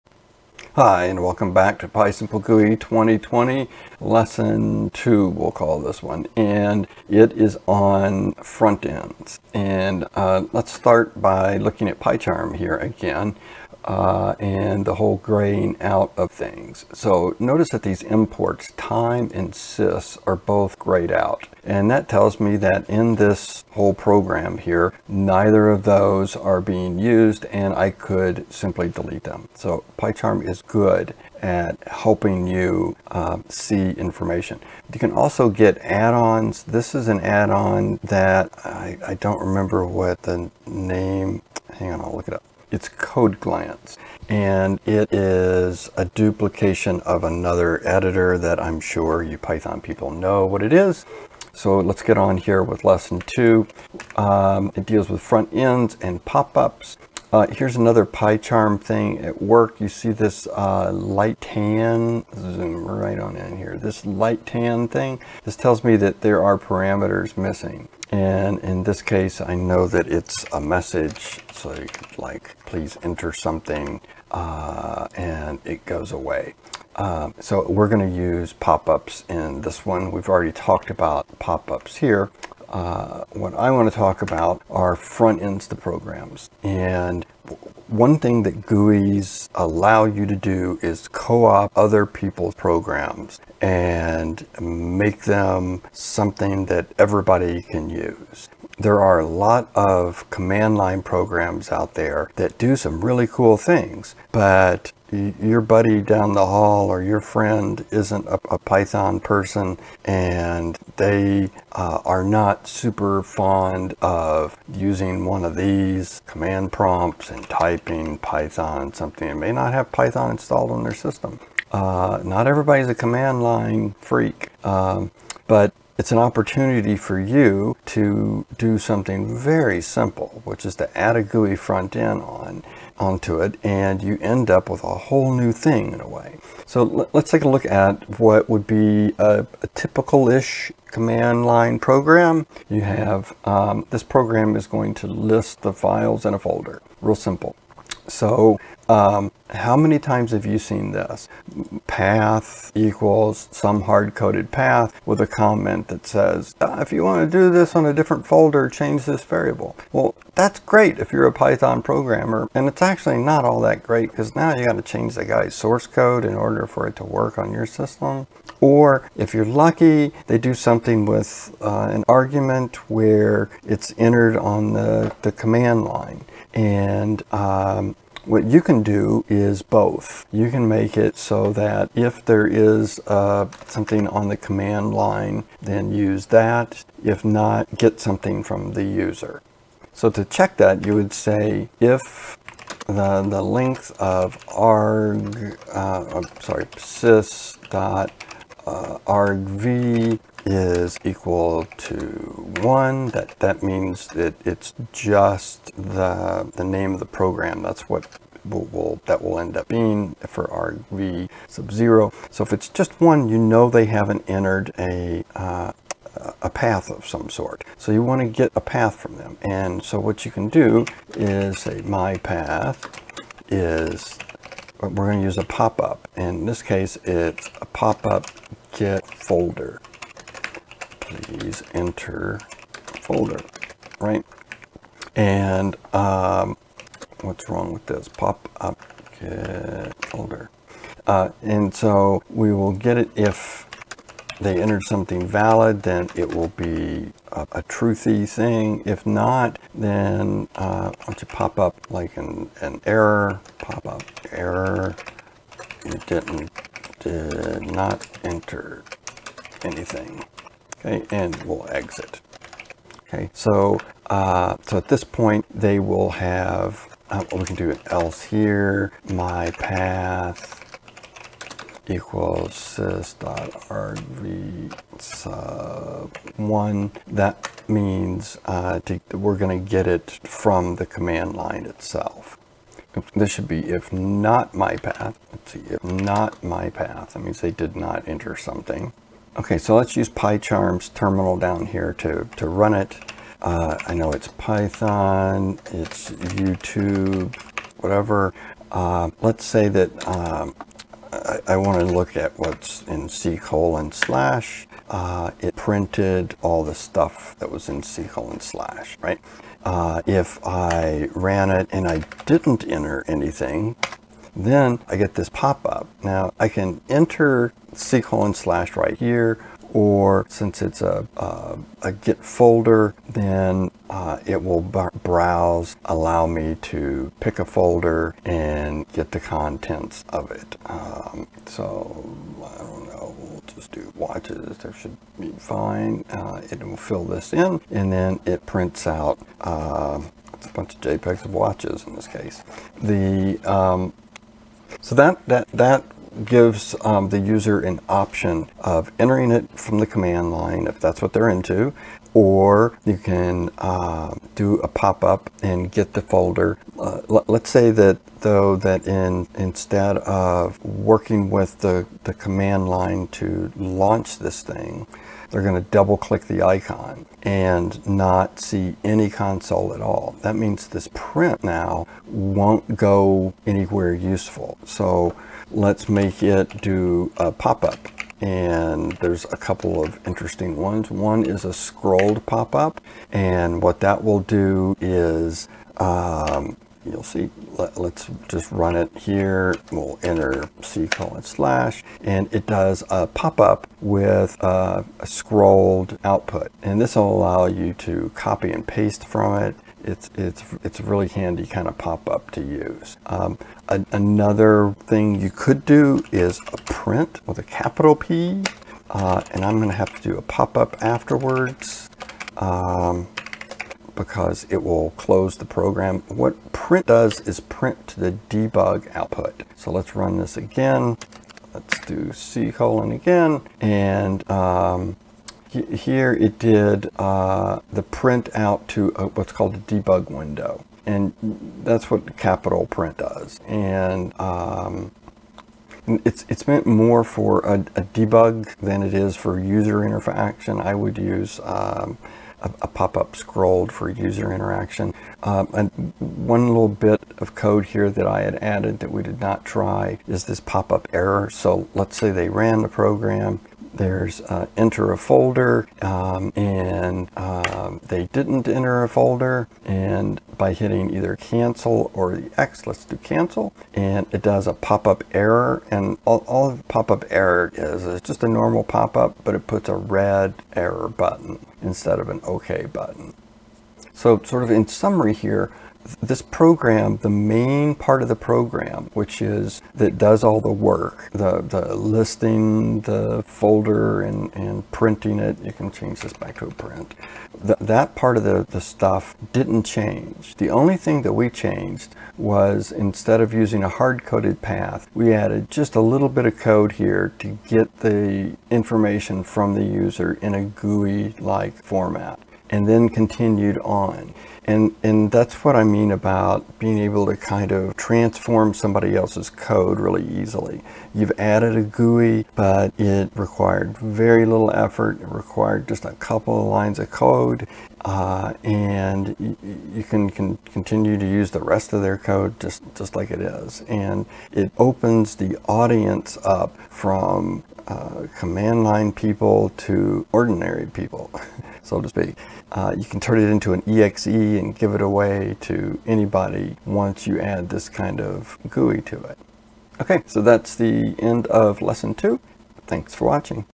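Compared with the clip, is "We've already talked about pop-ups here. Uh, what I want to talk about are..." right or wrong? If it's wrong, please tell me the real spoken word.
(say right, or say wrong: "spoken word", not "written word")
right.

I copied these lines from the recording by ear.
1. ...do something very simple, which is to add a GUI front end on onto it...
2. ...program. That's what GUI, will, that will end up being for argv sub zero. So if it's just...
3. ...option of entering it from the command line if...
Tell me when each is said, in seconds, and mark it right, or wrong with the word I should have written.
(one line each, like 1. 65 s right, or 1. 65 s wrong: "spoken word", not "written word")
1. 128 s right
2. 207 s wrong: "Will", not "GUI"
3. 347 s right.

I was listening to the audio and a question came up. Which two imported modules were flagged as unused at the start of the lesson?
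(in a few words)
time and sys.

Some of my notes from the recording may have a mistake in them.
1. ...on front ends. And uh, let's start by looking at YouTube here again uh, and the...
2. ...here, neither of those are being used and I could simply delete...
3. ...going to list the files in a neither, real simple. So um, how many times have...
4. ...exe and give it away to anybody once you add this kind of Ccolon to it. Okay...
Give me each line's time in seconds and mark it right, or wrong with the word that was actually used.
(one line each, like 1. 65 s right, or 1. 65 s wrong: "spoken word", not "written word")
1. 7 s wrong: "PyCharm", not "YouTube"
2. 24 s right
3. 144 s wrong: "folder", not "neither"
4. 533 s wrong: "GUI", not "Ccolon".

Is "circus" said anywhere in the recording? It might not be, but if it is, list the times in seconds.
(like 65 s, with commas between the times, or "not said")
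not said.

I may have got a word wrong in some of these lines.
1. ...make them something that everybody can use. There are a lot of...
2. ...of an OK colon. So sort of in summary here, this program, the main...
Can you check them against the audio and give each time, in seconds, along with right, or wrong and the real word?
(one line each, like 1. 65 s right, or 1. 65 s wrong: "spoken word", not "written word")
1. 94 s right
2. 471 s wrong: "button", not "colon".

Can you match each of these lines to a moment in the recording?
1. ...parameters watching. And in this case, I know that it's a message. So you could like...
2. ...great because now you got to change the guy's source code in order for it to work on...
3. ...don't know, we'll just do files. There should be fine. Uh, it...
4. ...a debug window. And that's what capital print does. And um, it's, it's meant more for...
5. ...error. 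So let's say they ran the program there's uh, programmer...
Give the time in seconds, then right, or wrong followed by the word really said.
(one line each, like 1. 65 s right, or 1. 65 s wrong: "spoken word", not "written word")
1. 66 s wrong: "missing", not "watching"
2. 163 s right
3. 332 s wrong: "watches", not "files"
4. 429 s right
5. 450 s wrong: "enter", not "programmer".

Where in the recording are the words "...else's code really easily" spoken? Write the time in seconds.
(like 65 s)
508 s.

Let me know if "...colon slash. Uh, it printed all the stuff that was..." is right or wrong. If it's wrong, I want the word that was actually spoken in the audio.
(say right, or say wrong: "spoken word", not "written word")
right.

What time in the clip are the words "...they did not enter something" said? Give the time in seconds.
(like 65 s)
287 s.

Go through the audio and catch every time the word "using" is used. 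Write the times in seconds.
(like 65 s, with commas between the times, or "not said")
114 s, 493 s.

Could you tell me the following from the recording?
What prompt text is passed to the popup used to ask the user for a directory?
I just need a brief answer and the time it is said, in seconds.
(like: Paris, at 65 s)
please enter folder, at 231 s.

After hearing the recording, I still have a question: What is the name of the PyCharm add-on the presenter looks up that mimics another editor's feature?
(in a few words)
Code Glance.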